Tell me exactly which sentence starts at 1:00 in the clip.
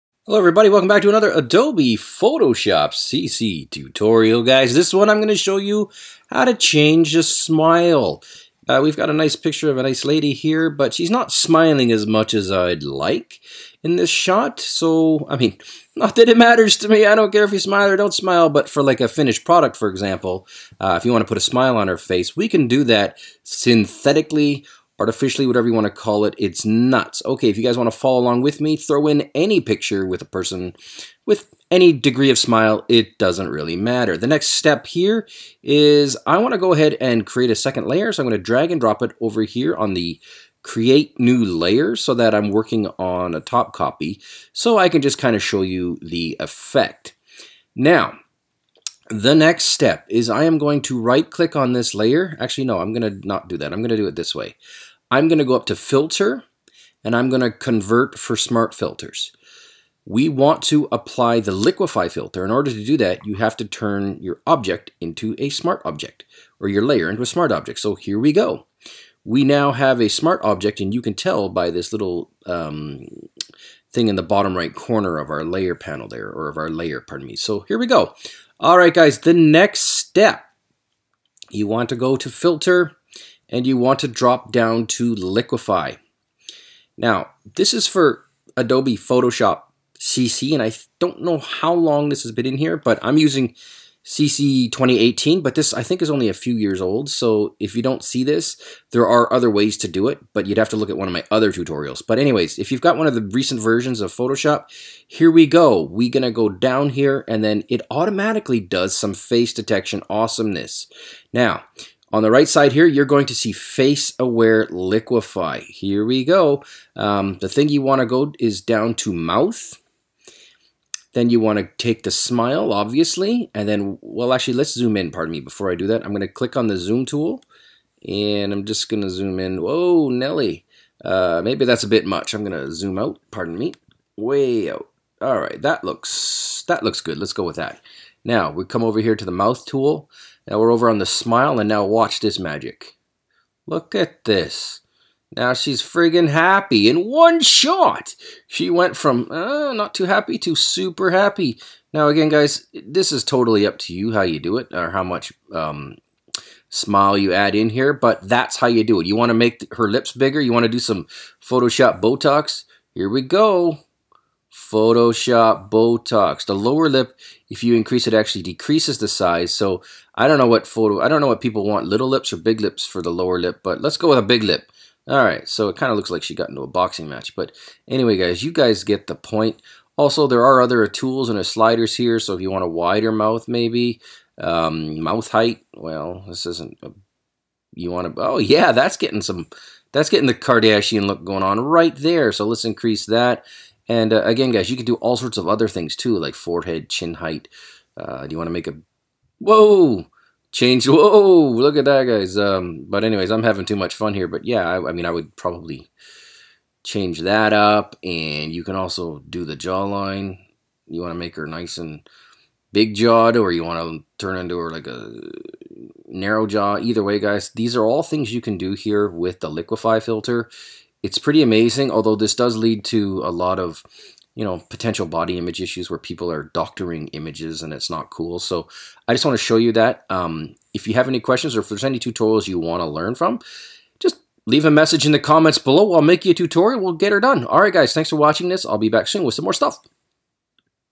We want to apply the liquify filter.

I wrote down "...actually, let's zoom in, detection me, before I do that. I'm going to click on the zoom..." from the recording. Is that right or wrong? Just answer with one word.
wrong.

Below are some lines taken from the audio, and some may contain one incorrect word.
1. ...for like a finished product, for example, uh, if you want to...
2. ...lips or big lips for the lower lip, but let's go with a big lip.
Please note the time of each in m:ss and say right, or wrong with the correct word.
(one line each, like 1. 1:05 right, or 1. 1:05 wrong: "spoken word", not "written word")
1. 0:18 right
2. 2:52 right.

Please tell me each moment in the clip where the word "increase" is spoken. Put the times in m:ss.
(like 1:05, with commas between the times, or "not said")
2:47, 3:12.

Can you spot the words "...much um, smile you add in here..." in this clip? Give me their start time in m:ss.
2:35.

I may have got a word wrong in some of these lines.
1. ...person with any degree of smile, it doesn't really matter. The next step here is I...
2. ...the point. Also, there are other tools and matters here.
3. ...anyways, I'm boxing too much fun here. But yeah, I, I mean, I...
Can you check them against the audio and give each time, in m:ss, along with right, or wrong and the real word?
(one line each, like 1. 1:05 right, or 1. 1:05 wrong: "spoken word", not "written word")
1. 0:30 right
2. 2:59 wrong: "sliders", not "matters"
3. 3:23 wrong: "having", not "boxing".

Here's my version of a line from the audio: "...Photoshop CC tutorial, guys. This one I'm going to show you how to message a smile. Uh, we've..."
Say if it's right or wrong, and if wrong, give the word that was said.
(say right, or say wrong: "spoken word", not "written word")
wrong: "change", not "message".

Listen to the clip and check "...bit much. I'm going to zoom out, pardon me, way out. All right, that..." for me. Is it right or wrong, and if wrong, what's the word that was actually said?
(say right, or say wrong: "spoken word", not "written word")
right.